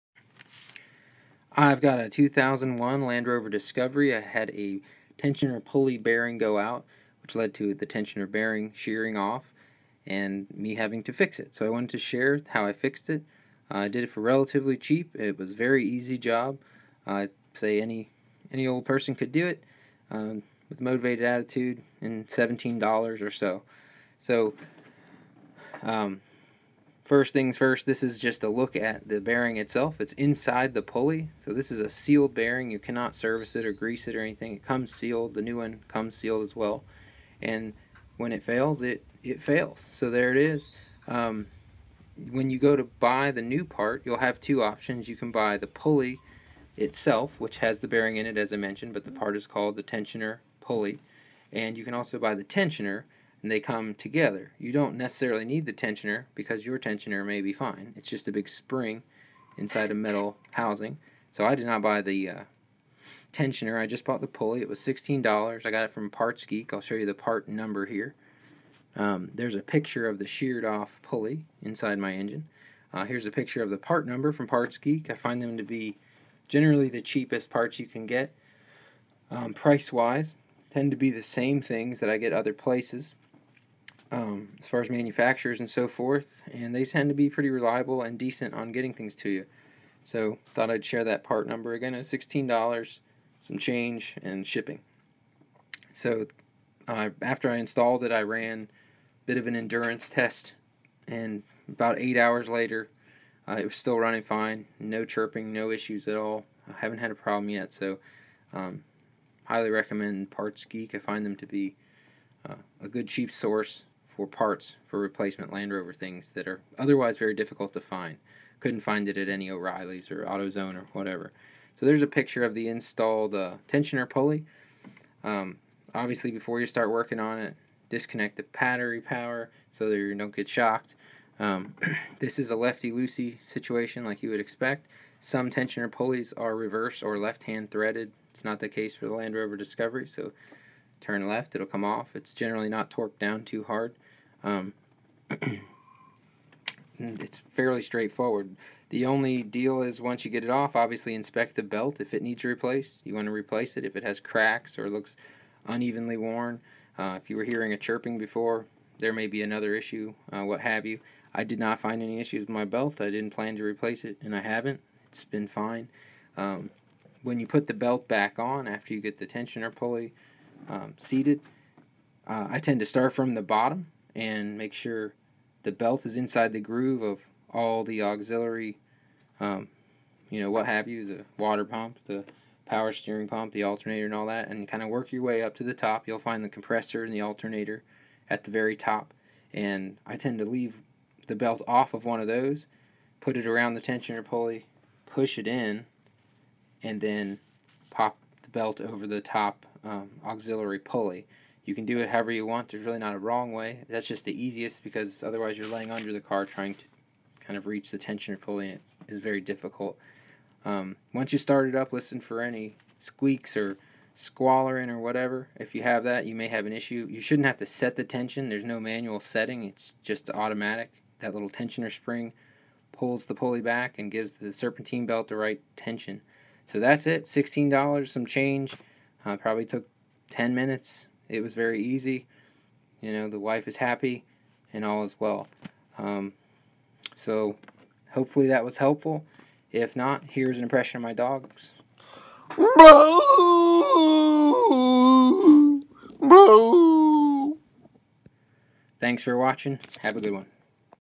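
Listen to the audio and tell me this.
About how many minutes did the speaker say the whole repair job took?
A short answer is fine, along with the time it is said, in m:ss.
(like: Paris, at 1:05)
10 minutes, at 3:50.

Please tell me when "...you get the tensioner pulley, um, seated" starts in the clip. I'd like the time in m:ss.
2:48.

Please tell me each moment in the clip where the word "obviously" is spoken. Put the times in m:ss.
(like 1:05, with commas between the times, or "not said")
2:05, 2:30.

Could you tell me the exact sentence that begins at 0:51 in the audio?
And you can also buy the tensioner, and they come together.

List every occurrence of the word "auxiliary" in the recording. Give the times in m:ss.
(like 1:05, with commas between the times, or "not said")
2:58, 3:20.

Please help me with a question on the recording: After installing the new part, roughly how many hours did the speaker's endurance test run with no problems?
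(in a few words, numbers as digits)
8 hours.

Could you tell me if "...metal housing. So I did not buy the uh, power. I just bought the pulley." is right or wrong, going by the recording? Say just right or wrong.
wrong.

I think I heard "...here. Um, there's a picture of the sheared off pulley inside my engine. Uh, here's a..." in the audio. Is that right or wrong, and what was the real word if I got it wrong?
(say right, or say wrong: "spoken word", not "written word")
right.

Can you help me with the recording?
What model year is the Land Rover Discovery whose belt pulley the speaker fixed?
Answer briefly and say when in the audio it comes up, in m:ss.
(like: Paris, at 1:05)
2001, at 0:02.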